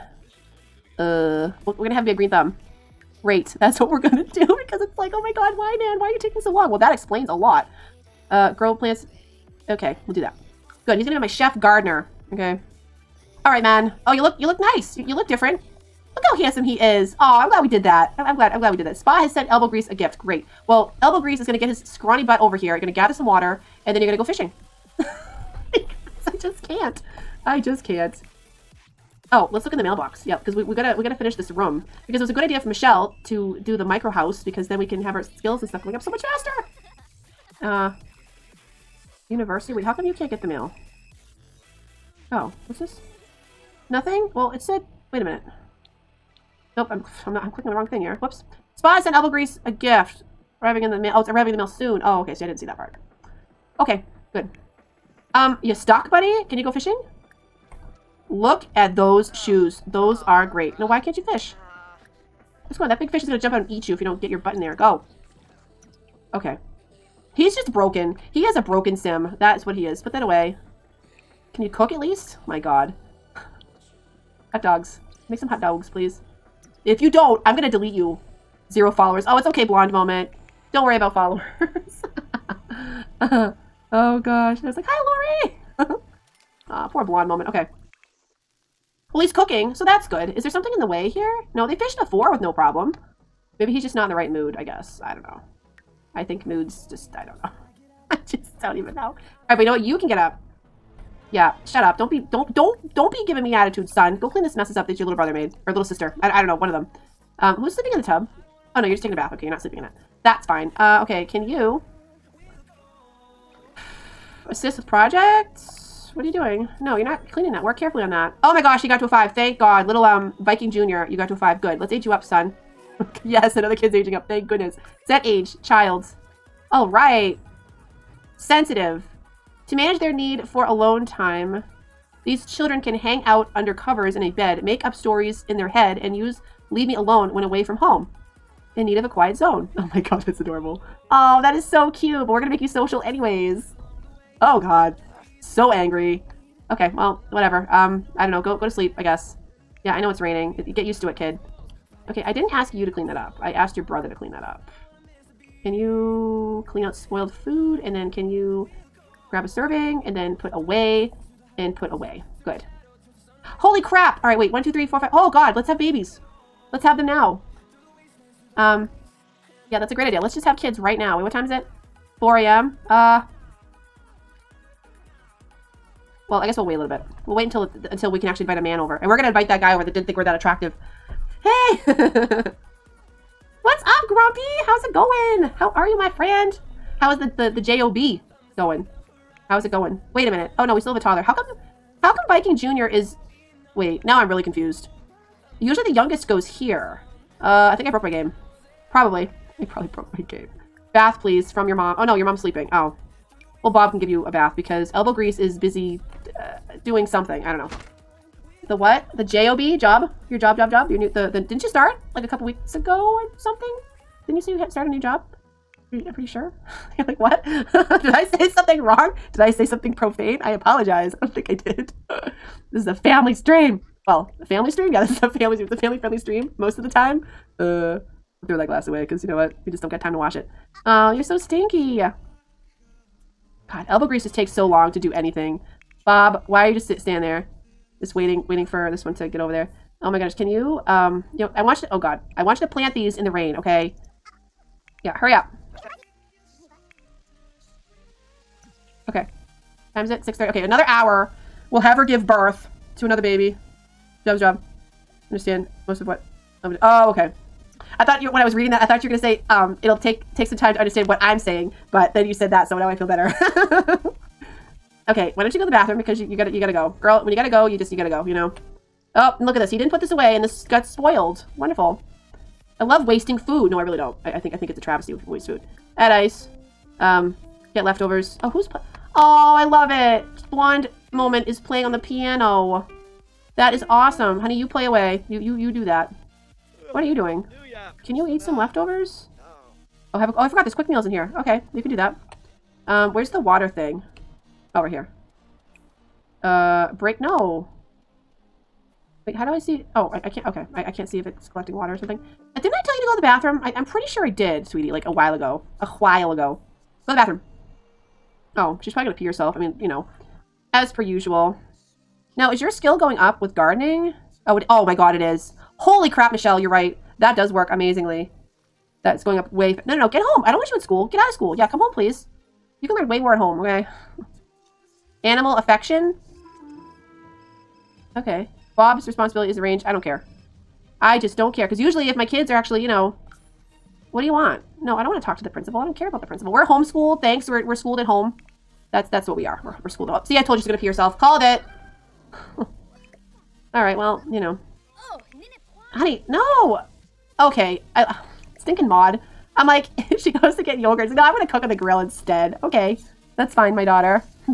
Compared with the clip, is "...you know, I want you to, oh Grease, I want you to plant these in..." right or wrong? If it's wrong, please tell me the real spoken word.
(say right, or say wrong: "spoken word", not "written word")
wrong: "God", not "Grease".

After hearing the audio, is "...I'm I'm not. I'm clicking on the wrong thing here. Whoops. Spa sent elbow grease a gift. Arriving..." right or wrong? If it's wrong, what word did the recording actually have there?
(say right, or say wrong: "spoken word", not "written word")
right.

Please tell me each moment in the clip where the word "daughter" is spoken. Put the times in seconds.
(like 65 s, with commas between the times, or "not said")
353 s.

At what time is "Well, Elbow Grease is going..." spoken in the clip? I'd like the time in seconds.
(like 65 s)
20 s.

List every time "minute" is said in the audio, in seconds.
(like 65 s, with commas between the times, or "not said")
45 s, 190 s.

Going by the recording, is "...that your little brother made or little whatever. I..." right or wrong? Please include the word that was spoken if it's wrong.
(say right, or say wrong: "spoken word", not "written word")
wrong: "sister", not "whatever".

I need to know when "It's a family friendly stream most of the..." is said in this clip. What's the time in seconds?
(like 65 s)
225 s.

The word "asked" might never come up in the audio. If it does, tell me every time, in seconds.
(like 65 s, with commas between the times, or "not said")
153 s.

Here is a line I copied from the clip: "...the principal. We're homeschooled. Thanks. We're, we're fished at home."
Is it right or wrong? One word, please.
wrong.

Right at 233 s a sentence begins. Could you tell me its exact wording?
God, elbow grease just takes so long to do anything.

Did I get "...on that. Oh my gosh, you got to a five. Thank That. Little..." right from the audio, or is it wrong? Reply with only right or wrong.
wrong.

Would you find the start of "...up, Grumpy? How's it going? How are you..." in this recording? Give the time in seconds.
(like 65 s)
183 s.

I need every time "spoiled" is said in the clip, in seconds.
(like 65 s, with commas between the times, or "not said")
156 s, 270 s.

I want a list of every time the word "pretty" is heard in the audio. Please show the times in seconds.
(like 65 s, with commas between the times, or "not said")
216 s, 303 s.